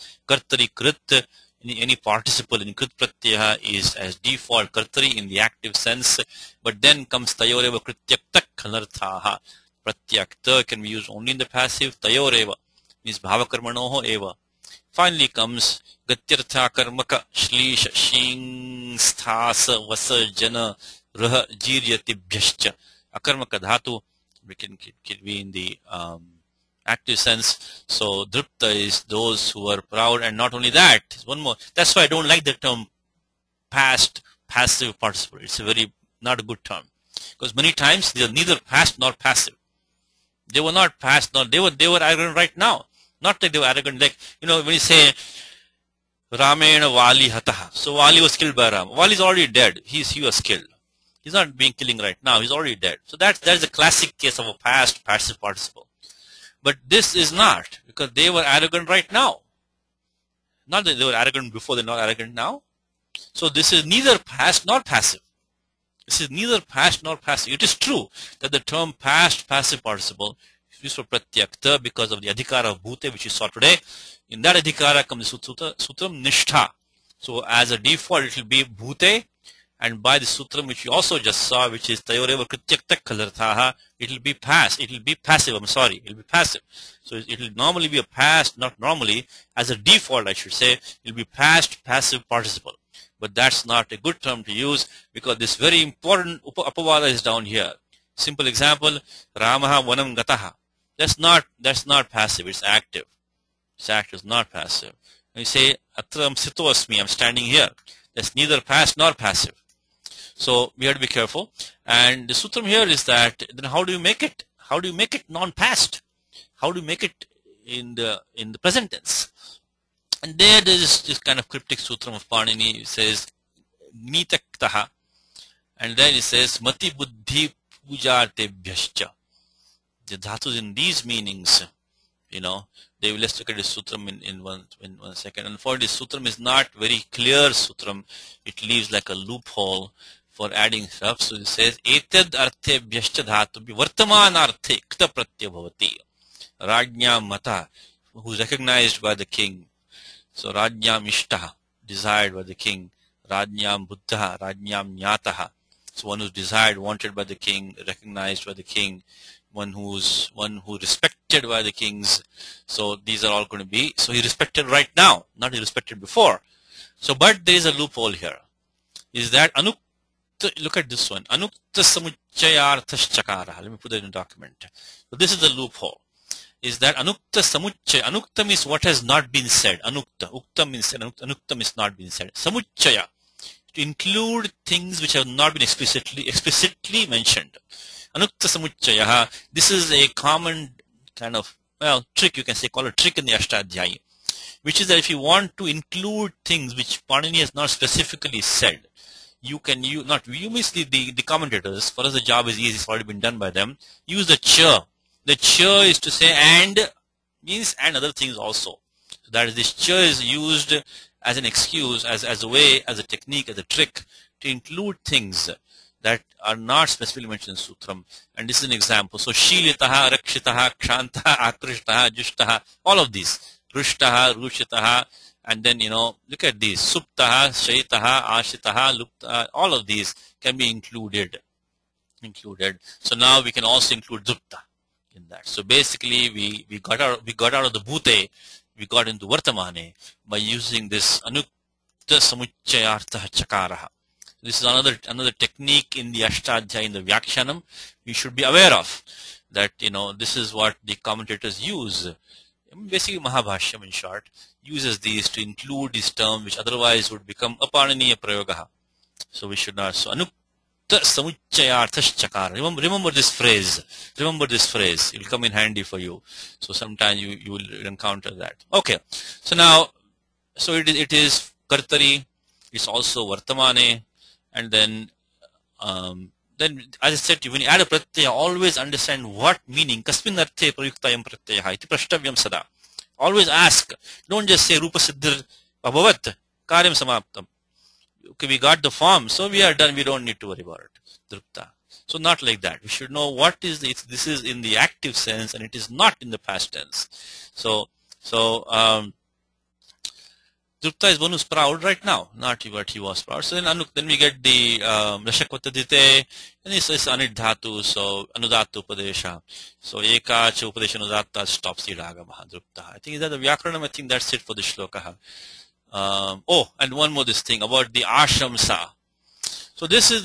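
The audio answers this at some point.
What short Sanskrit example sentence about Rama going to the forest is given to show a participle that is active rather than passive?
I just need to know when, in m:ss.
1:39.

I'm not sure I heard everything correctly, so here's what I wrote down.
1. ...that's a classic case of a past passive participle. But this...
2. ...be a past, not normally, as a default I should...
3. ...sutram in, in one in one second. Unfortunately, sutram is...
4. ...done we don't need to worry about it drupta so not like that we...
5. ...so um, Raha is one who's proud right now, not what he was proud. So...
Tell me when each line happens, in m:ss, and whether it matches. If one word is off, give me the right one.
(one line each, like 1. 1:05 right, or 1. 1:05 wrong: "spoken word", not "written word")
1. 0:53 right
2. 1:27 right
3. 2:13 right
4. 4:49 right
5. 4:58 wrong: "Drupta", not "Raha".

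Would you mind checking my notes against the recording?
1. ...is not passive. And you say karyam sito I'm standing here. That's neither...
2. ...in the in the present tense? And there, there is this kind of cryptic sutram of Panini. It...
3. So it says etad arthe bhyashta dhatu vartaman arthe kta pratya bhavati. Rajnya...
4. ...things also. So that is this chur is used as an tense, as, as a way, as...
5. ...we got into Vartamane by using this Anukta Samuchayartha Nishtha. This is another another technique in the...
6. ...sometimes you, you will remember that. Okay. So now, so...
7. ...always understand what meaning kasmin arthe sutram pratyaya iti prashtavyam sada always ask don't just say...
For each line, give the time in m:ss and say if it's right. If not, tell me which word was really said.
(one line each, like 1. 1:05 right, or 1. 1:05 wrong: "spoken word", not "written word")
1. 1:44 wrong: "atram", not "karyam"
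2. 1:57 right
3. 2:21 right
4. 3:28 wrong: "excuse", not "tense"
5. 3:58 wrong: "Chakaraha", not "Nishtha"
6. 4:26 wrong: "encounter", not "remember"
7. 4:38 wrong: "prayuktayam", not "sutram".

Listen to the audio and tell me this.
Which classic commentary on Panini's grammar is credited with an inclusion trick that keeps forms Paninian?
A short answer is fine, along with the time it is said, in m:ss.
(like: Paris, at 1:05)
Mahabhashyam, at 4:13.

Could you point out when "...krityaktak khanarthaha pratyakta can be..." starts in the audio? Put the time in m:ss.
0:07.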